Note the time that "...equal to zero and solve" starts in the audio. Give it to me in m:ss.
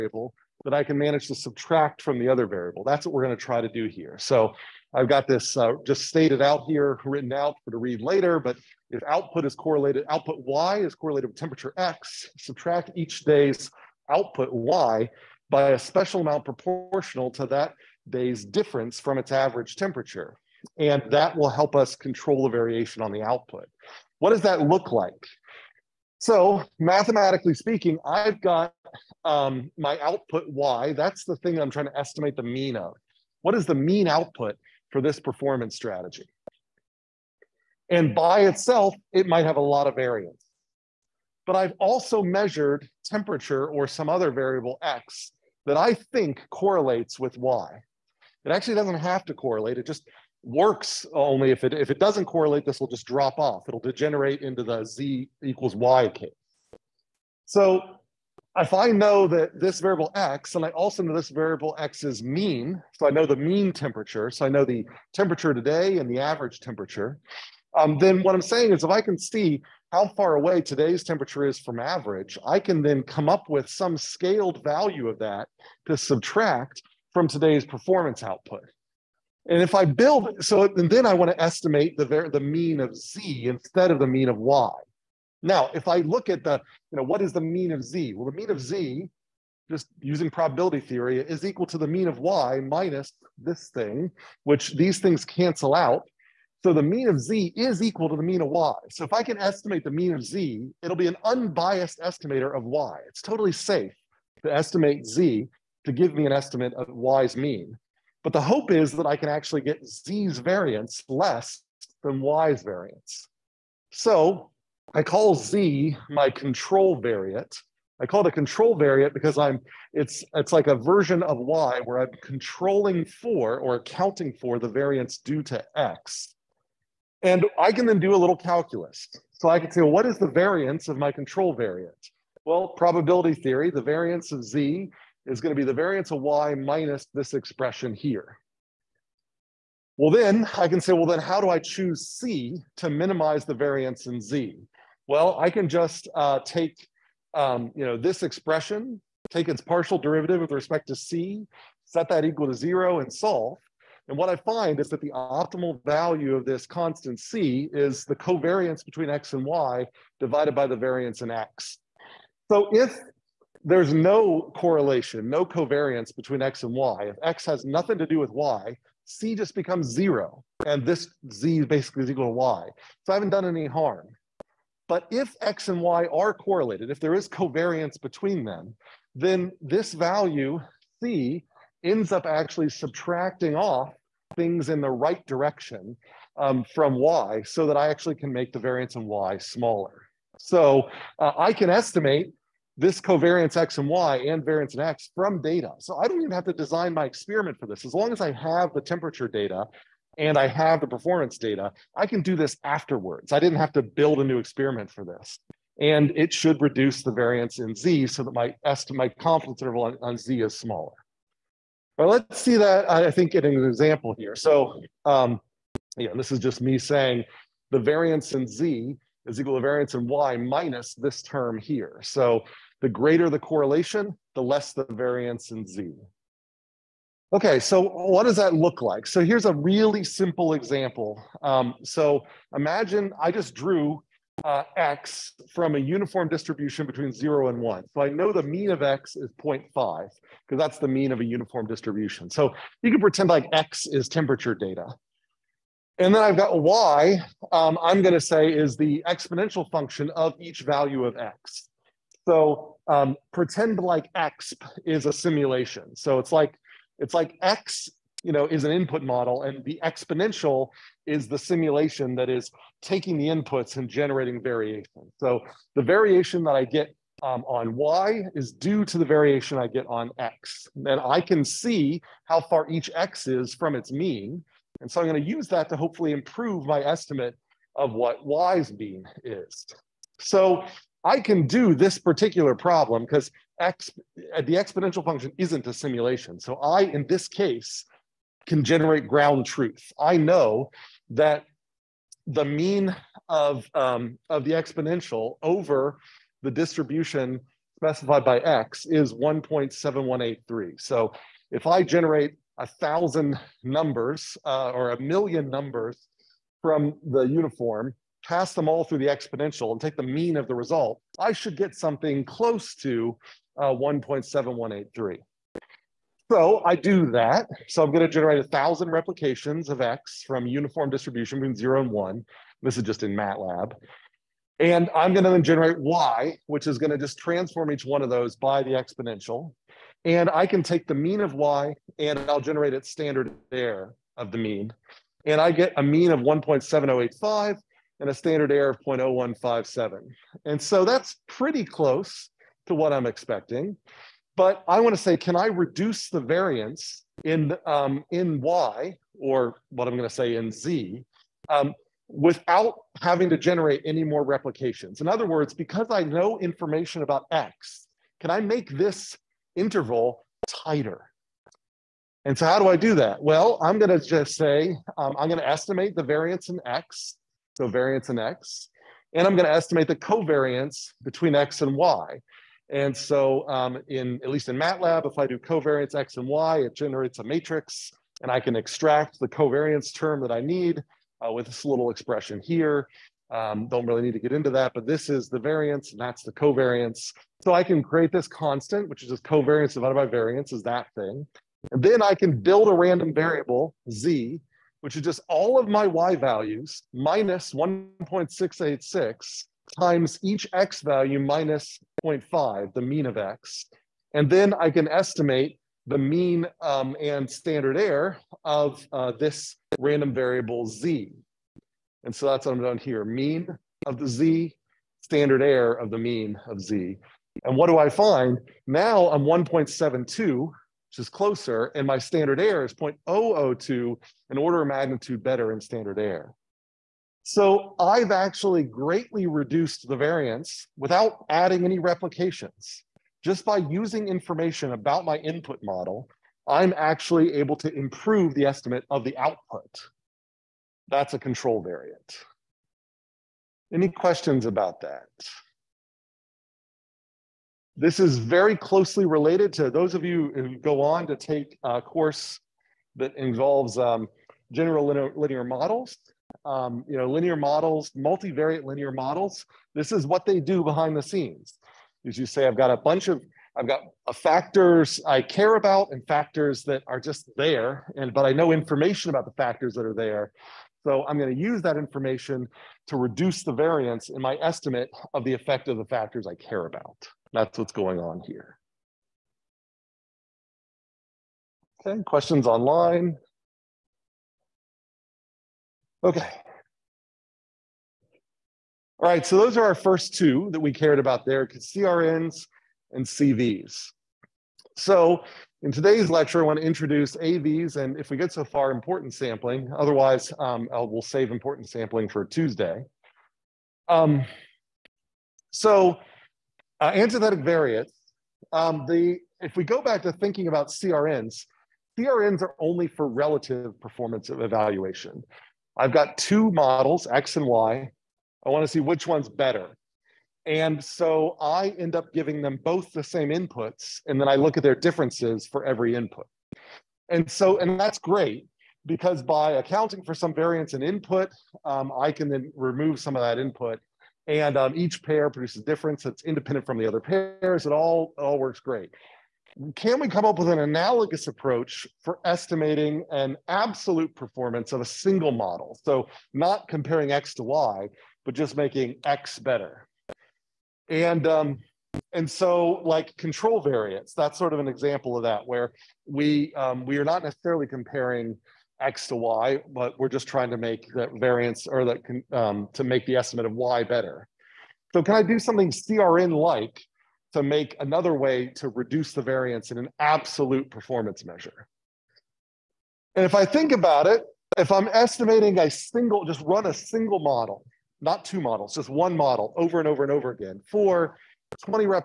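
2:32.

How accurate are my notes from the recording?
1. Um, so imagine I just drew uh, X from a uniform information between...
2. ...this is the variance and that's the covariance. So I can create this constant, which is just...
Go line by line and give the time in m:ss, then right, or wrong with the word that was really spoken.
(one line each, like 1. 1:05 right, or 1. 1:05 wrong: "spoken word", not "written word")
1. 3:51 wrong: "distribution", not "information"
2. 6:24 right.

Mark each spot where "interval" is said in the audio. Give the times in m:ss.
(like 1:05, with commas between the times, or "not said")
3:29, 5:59.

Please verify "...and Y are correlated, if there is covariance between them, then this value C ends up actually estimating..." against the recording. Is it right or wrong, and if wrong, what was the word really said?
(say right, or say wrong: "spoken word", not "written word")
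wrong: "subtracting", not "estimating".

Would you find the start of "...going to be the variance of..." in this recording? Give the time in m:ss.
2:15.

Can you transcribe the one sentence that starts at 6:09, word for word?
And I'm gonna estimate the covariance between X and Y.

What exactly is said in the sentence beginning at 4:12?
So um, pretend like X is a simulation.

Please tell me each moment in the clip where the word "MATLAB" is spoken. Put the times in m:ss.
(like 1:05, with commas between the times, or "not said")
5:23, 6:14.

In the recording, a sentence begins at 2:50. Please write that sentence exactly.
And this Z basically is equal to Y.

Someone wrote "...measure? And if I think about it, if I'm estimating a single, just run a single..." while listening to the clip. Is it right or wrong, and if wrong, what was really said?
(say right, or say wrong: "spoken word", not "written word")
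right.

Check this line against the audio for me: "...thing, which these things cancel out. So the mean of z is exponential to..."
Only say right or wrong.
wrong.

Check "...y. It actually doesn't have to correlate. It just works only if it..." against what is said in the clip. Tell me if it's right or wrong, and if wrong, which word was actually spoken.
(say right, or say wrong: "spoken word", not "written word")
right.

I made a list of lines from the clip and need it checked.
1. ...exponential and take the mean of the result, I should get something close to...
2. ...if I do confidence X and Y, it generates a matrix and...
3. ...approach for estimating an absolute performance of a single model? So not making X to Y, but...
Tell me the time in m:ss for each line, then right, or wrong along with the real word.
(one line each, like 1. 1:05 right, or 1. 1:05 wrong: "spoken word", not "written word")
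1. 5:09 right
2. 6:15 wrong: "covariance", not "confidence"
3. 9:01 wrong: "comparing", not "making".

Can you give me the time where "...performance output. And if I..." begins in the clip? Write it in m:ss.
1:17.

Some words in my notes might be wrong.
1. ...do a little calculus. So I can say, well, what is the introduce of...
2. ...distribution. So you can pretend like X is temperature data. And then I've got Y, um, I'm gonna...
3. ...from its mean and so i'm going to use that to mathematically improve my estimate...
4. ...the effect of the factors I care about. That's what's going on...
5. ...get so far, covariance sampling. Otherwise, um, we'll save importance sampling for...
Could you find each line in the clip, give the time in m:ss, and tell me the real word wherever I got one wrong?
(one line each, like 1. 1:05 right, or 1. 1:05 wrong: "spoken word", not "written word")
1. 2:07 wrong: "variance", not "introduce"
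2. 4:01 right
3. 4:33 wrong: "hopefully", not "mathematically"
4. 7:55 right
5. 8:18 wrong: "importance", not "covariance".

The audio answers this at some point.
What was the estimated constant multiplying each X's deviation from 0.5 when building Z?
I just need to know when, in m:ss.
6:37.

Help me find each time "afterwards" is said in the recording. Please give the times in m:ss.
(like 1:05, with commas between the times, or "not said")
3:22.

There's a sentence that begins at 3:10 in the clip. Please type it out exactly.
So uh, I can estimate this covariance X and Y and variance in X from data.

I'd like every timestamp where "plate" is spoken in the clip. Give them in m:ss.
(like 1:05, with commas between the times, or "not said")
not said.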